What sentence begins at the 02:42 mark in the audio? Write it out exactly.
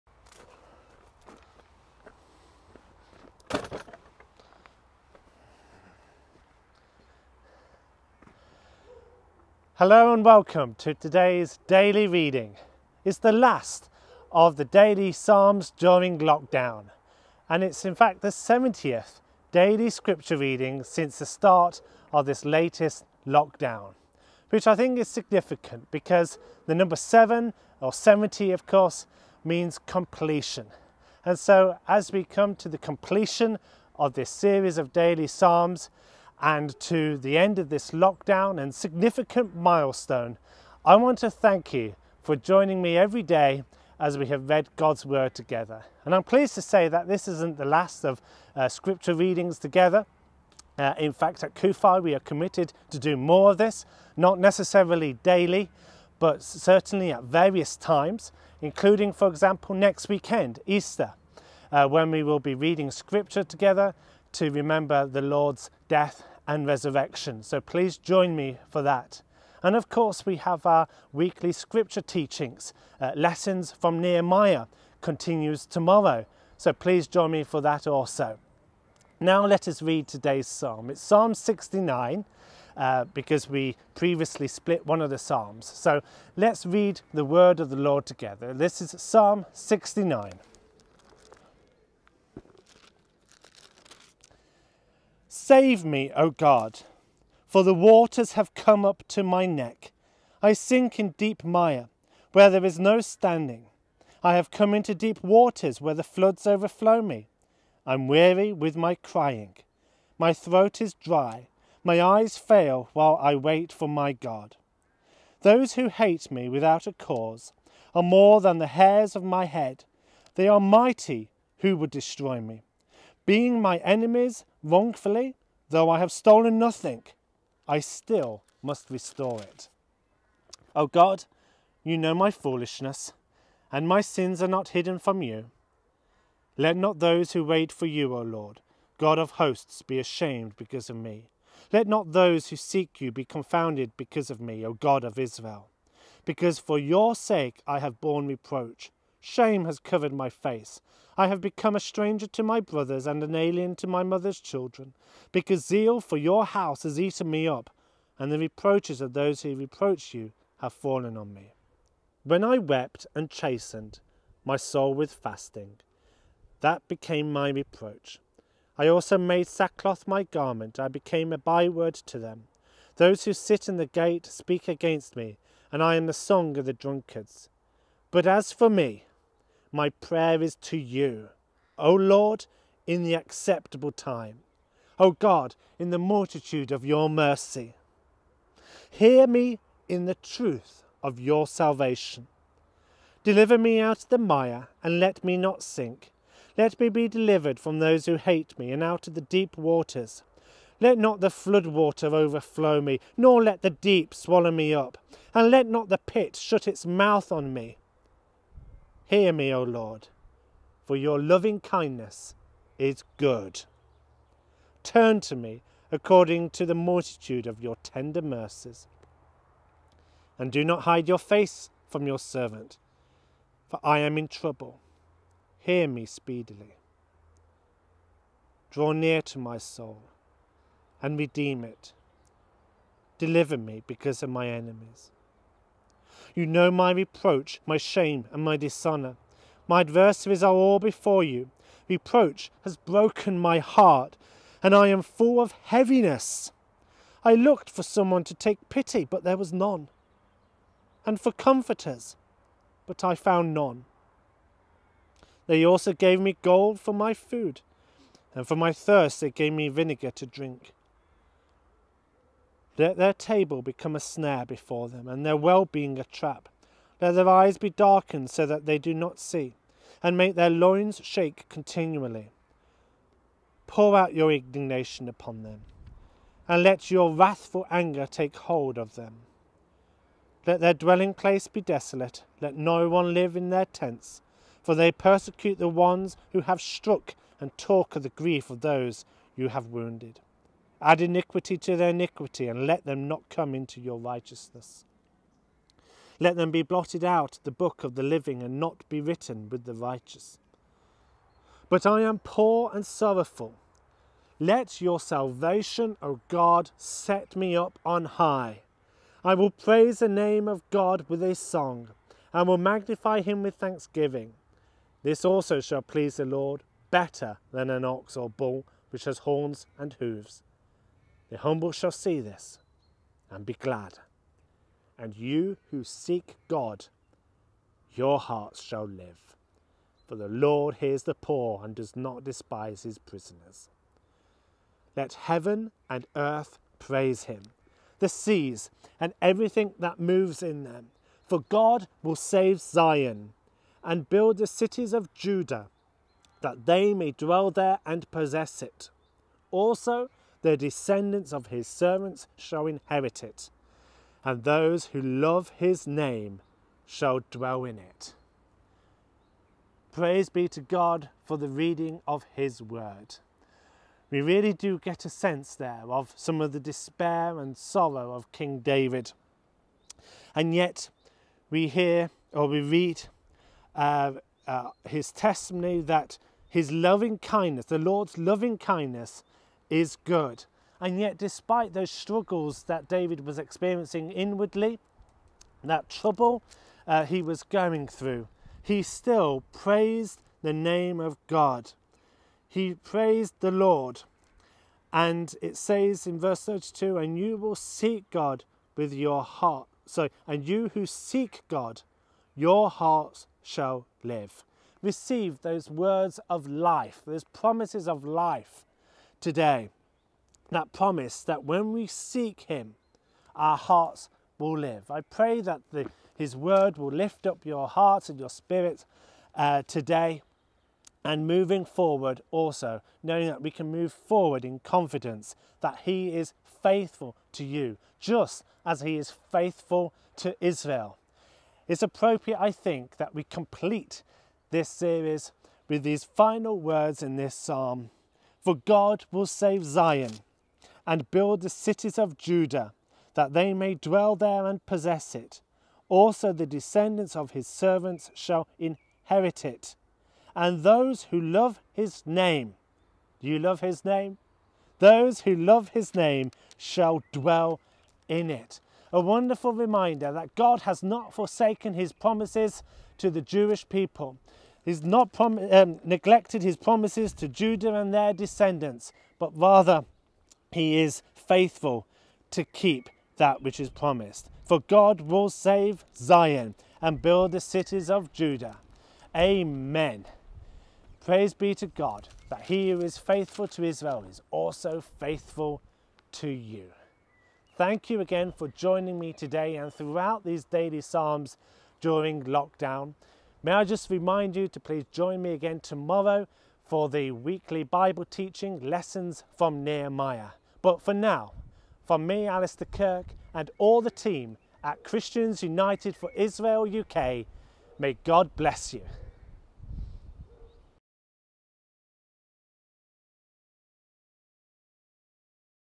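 When I wept and chastened my soul with fasting, that became my reproach.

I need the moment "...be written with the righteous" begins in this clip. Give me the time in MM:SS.
04:58.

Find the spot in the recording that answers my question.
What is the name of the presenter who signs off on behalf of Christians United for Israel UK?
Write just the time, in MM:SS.
08:22.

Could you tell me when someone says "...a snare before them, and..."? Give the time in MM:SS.
04:23.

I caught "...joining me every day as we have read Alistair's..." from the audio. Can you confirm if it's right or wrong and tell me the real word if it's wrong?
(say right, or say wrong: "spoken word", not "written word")
wrong: "God", not "Alistair".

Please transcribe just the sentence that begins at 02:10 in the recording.
O oh God, you know my foolishness, and my sins are not hidden from you.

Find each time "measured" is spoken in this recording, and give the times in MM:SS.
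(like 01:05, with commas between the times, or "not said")
not said.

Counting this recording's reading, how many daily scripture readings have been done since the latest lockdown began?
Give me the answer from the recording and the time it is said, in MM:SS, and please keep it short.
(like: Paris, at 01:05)
70, at 00:18.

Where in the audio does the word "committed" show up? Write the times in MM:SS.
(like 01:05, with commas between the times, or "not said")
00:52.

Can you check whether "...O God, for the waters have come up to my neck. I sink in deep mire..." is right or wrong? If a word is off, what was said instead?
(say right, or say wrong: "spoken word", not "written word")
right.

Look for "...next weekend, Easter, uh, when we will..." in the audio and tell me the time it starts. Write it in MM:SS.
00:59.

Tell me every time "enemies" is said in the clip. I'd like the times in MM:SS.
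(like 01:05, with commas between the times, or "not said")
02:03, 03:54.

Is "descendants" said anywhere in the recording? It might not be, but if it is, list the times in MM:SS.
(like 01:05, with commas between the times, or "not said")
05:50, 07:26, 07:48.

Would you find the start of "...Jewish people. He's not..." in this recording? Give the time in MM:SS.
07:43.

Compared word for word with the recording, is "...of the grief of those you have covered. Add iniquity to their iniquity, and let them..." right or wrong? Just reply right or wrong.
wrong.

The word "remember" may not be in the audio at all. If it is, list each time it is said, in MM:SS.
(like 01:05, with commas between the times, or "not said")
01:04.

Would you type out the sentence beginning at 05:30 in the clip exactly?
For the Lord hears the poor and does not despise his prisoners.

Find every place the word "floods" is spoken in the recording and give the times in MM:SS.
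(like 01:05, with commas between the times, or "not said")
01:46, 03:21.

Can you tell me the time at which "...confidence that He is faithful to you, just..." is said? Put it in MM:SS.
07:04.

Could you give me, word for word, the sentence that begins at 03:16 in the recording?
Let me be delivered from those who hate me, and out of the deep waters.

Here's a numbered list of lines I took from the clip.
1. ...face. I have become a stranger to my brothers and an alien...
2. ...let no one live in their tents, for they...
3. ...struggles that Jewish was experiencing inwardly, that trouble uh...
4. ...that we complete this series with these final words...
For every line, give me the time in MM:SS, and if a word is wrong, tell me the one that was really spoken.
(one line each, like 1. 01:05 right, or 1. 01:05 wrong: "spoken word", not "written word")
1. 02:30 right
2. 04:42 right
3. 06:21 wrong: "David", not "Jewish"
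4. 07:12 right.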